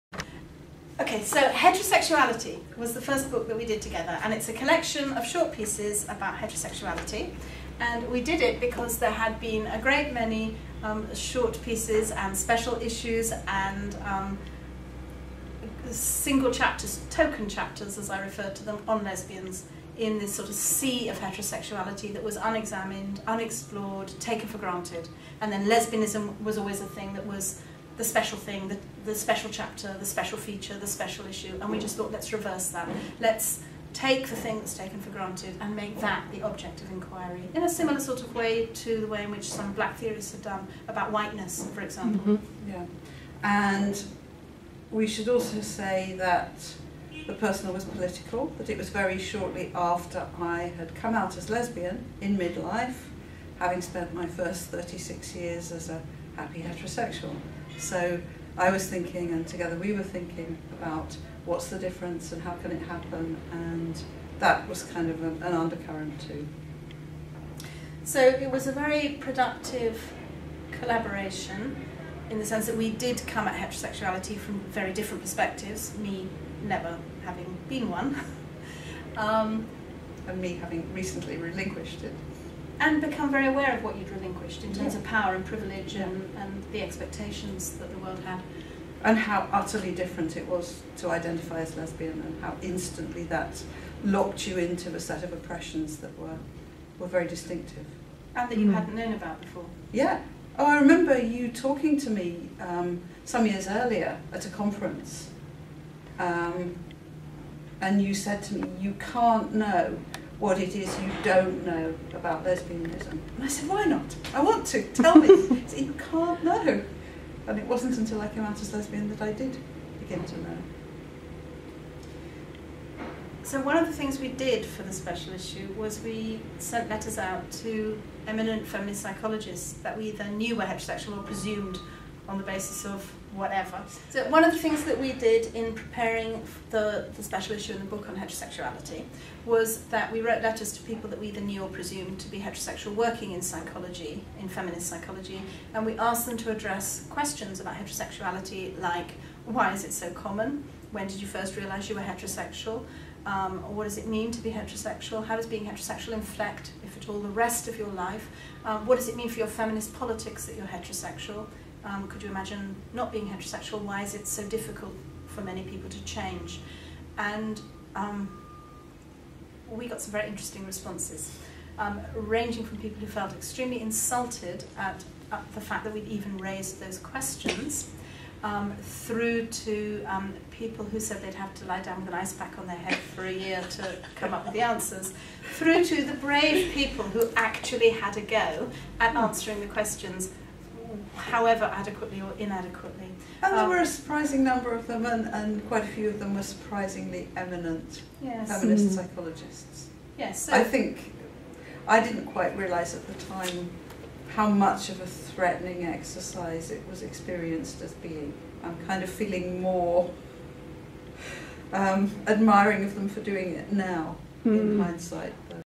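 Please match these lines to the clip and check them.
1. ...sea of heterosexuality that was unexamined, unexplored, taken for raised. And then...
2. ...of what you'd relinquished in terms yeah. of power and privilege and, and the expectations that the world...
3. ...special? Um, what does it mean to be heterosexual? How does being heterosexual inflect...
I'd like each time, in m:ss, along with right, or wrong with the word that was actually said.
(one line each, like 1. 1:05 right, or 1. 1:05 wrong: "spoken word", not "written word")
1. 0:20 wrong: "granted", not "raised"
2. 1:23 right
3. 2:32 wrong: "heterosexual", not "special".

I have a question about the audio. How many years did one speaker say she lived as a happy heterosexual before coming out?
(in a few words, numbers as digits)
36.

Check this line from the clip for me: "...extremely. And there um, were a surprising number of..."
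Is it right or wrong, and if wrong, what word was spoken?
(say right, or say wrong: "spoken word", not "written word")
wrong: "inadequately", not "extremely".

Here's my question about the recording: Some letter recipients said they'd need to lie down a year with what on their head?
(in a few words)
an ice pack.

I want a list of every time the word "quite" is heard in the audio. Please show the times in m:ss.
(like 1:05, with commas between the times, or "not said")
3:15, 3:22.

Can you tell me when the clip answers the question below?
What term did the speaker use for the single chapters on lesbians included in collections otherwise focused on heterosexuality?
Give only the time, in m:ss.
0:17.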